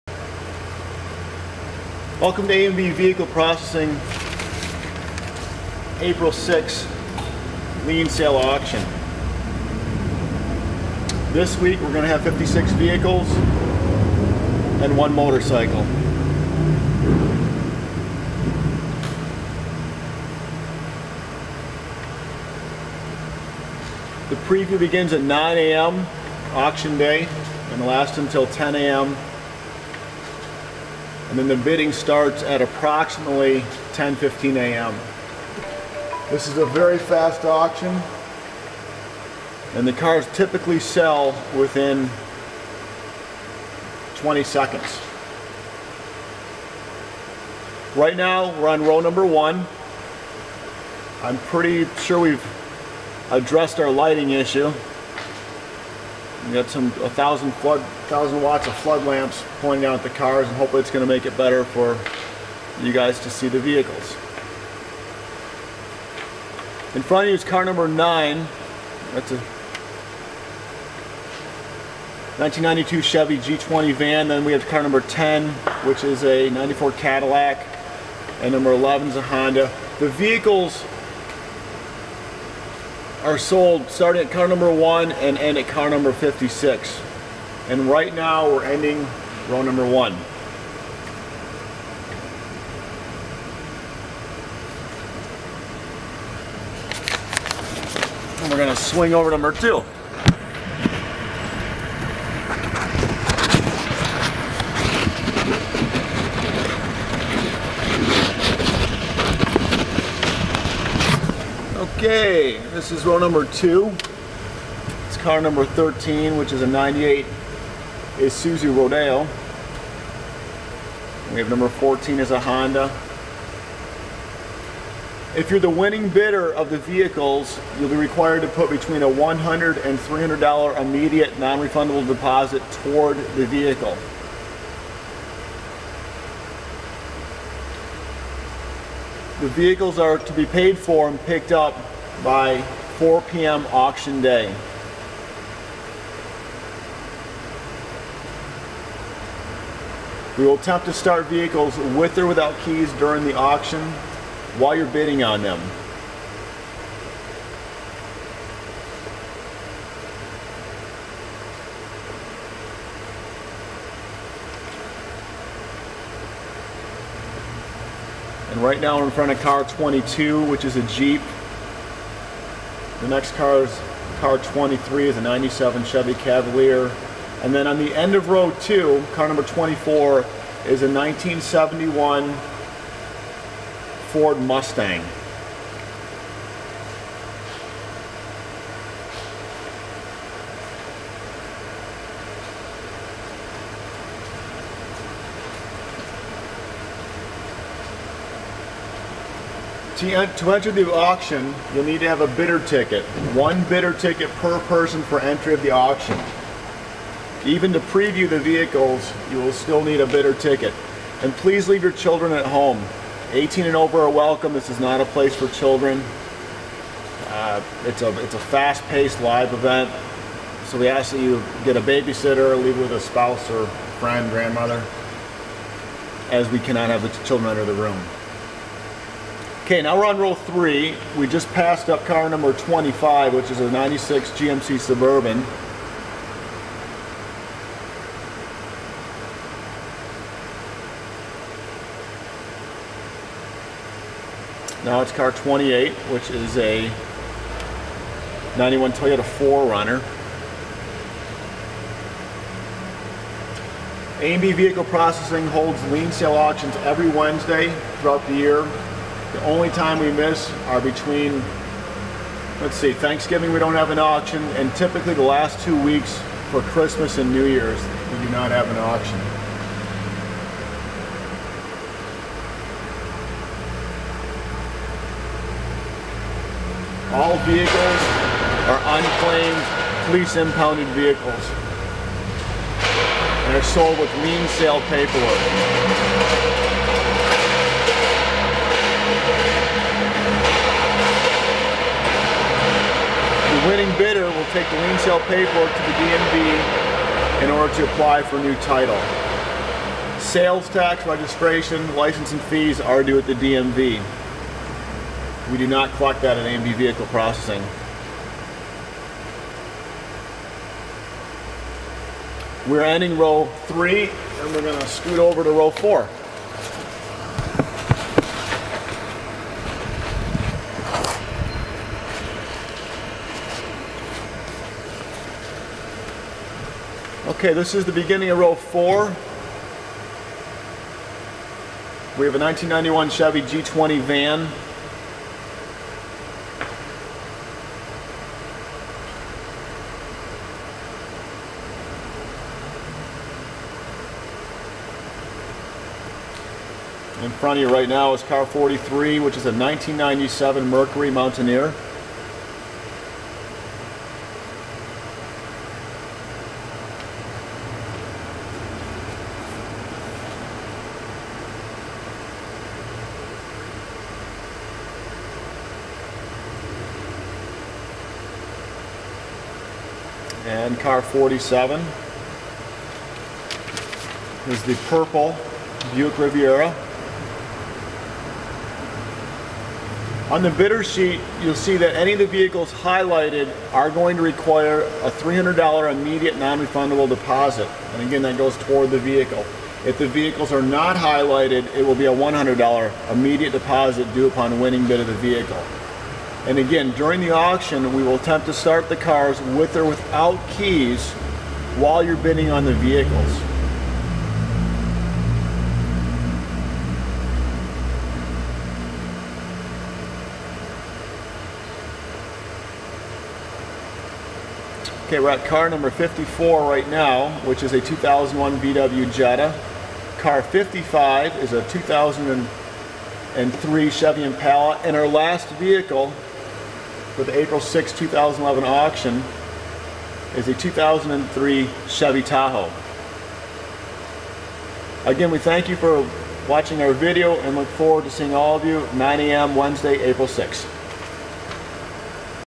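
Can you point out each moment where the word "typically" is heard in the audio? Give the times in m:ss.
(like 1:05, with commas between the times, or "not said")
0:40, 4:24.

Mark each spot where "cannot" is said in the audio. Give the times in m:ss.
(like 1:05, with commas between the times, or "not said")
3:46.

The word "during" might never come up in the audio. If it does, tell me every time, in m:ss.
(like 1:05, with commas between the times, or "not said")
2:32, 6:36.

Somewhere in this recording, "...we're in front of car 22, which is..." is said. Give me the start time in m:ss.
2:48.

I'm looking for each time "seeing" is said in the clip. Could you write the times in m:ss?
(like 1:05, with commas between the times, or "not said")
7:18.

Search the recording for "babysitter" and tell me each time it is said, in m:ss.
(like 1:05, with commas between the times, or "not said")
3:41.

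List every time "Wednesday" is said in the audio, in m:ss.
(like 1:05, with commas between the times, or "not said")
4:17, 7:19.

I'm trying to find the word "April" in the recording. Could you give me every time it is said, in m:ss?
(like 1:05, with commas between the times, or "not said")
0:06, 7:07, 7:20.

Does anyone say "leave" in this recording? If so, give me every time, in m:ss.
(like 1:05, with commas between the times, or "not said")
3:31, 3:42.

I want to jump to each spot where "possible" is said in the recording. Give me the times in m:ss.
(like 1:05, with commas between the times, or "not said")
not said.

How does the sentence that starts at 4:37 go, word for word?
All vehicles are unclaimed police impounded vehicles and are sold with lien sale paperwork.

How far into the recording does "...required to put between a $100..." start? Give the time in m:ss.
2:07.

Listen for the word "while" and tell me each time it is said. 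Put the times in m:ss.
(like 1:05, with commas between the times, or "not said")
2:34, 6:41.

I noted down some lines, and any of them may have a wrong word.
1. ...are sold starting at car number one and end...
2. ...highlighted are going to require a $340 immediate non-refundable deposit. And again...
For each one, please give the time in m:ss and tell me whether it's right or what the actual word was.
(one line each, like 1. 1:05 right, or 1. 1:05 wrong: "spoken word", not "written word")
1. 1:23 right
2. 6:22 wrong: "300", not "340".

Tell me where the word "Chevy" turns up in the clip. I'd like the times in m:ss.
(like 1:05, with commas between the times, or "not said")
1:13, 2:55, 5:33, 7:03, 7:11.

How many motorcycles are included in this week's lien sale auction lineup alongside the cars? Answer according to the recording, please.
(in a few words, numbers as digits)
1.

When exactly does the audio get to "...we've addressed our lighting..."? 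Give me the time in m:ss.
0:52.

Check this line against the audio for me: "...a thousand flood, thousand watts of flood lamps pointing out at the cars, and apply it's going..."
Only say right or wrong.
wrong.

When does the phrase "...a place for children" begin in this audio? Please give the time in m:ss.
3:35.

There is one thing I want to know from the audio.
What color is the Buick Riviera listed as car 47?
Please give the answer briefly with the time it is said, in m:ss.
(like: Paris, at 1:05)
Purple, at 6:14.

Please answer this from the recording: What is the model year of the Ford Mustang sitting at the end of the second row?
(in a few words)
1971.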